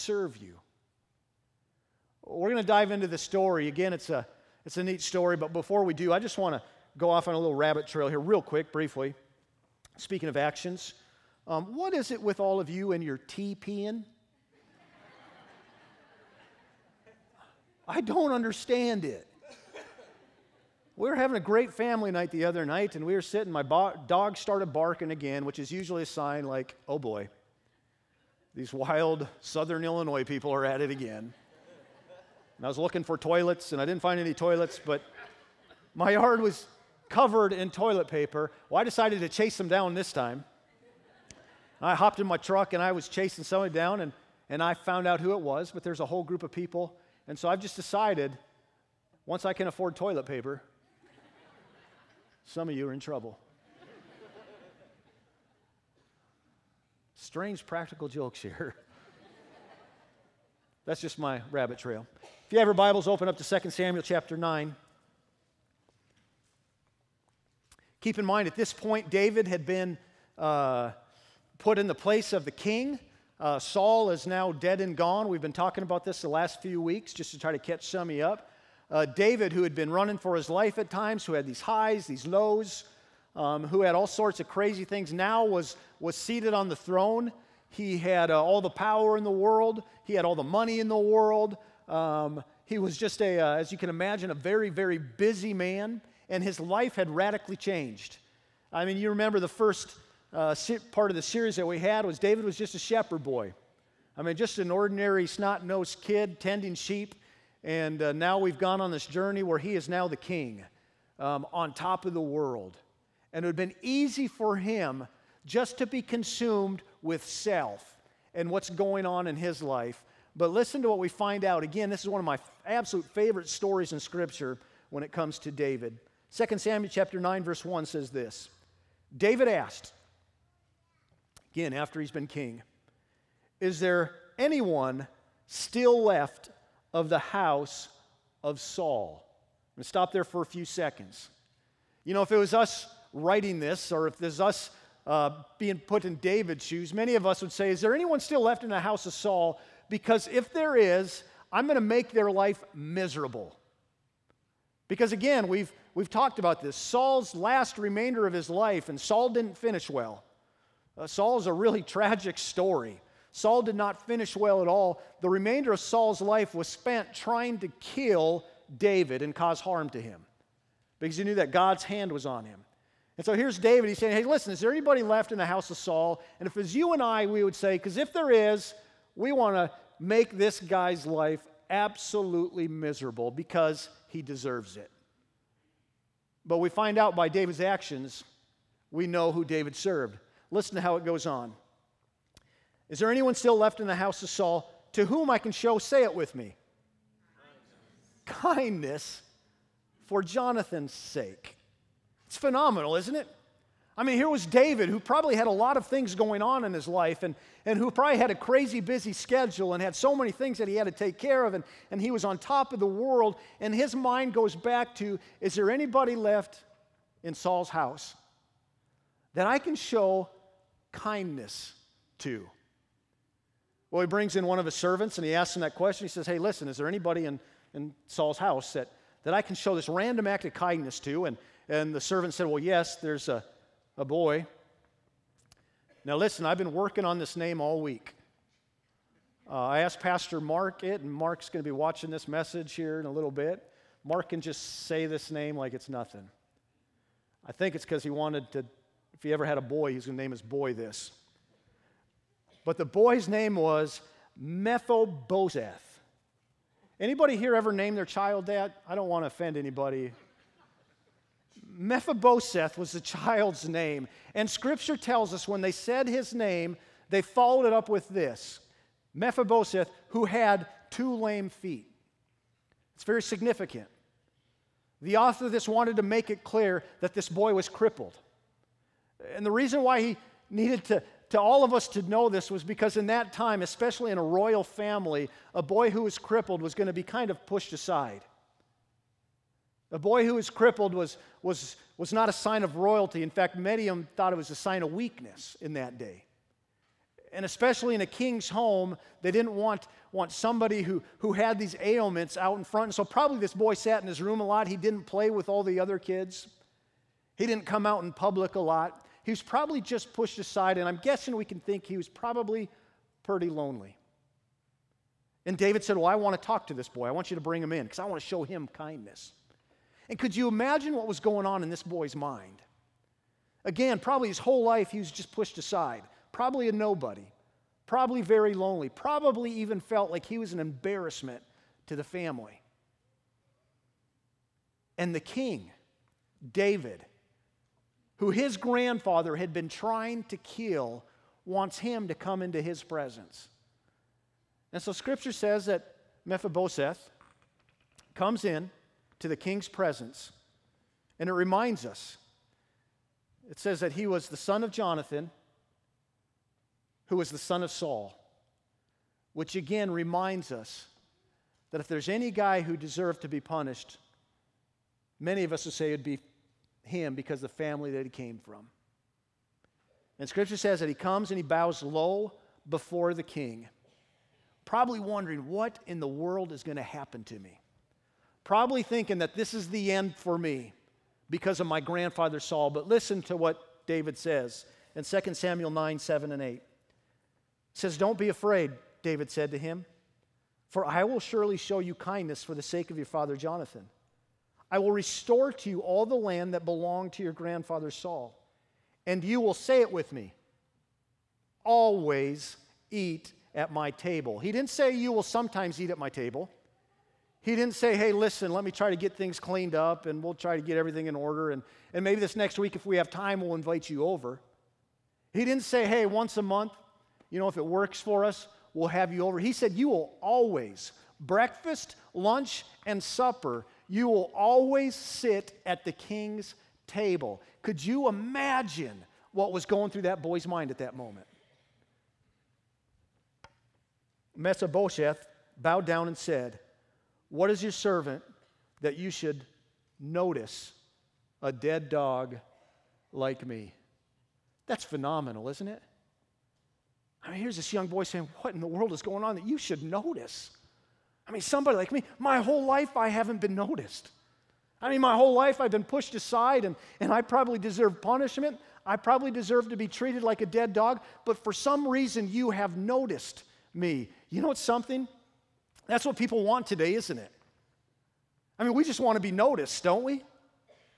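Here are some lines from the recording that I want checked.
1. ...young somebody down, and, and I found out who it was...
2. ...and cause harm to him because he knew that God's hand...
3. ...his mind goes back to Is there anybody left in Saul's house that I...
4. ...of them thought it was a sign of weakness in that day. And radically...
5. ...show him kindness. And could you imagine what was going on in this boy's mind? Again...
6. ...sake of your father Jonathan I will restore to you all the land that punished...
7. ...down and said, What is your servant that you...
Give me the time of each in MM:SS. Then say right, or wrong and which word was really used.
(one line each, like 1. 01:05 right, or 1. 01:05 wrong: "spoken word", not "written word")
1. 00:43 wrong: "chasing", not "young"
2. 02:49 right
3. 03:33 right
4. 04:53 wrong: "especially", not "radically"
5. 05:18 right
6. 06:32 wrong: "belonged", not "punished"
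7. 07:15 right.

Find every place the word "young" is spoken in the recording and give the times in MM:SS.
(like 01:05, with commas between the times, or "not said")
07:27.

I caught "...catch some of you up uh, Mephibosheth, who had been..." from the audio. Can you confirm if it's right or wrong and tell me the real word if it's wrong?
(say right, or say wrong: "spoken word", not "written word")
wrong: "David", not "Mephibosheth".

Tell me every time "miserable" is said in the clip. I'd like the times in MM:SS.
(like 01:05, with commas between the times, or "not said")
02:32, 03:02.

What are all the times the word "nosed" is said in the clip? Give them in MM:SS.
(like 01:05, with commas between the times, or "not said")
01:45.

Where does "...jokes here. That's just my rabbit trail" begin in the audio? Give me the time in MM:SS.
00:58.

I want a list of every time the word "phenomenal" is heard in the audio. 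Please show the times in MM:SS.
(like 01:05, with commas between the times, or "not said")
03:22, 07:24.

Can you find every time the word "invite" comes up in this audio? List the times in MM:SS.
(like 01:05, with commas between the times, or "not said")
06:53.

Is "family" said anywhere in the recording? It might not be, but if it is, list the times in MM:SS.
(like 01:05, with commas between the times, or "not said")
00:21, 04:44, 05:32, 06:07.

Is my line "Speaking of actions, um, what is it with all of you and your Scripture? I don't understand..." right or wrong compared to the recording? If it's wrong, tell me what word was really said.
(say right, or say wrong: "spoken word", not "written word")
wrong: "TPing", not "Scripture".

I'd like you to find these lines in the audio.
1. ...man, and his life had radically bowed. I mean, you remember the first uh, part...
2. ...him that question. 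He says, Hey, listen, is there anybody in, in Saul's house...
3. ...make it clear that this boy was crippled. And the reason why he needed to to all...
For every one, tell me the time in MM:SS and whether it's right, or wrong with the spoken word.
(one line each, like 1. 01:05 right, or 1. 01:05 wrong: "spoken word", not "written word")
1. 01:35 wrong: "changed", not "bowed"
2. 03:45 right
3. 04:36 right.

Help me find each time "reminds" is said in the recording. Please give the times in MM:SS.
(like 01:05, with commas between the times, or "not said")
05:51, 05:59.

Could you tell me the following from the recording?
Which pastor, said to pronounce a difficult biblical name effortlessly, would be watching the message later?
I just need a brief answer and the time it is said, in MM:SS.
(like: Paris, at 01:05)
Pastor Mark, at 03:59.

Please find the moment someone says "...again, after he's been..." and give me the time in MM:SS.
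02:11.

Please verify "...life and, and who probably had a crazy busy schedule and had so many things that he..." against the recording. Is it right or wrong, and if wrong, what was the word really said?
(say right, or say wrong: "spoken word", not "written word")
right.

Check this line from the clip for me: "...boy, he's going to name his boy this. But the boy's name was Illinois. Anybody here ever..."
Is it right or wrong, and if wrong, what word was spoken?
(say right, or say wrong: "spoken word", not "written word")
wrong: "Mephibosheth", not "Illinois".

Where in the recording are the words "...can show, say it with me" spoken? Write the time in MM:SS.
03:15.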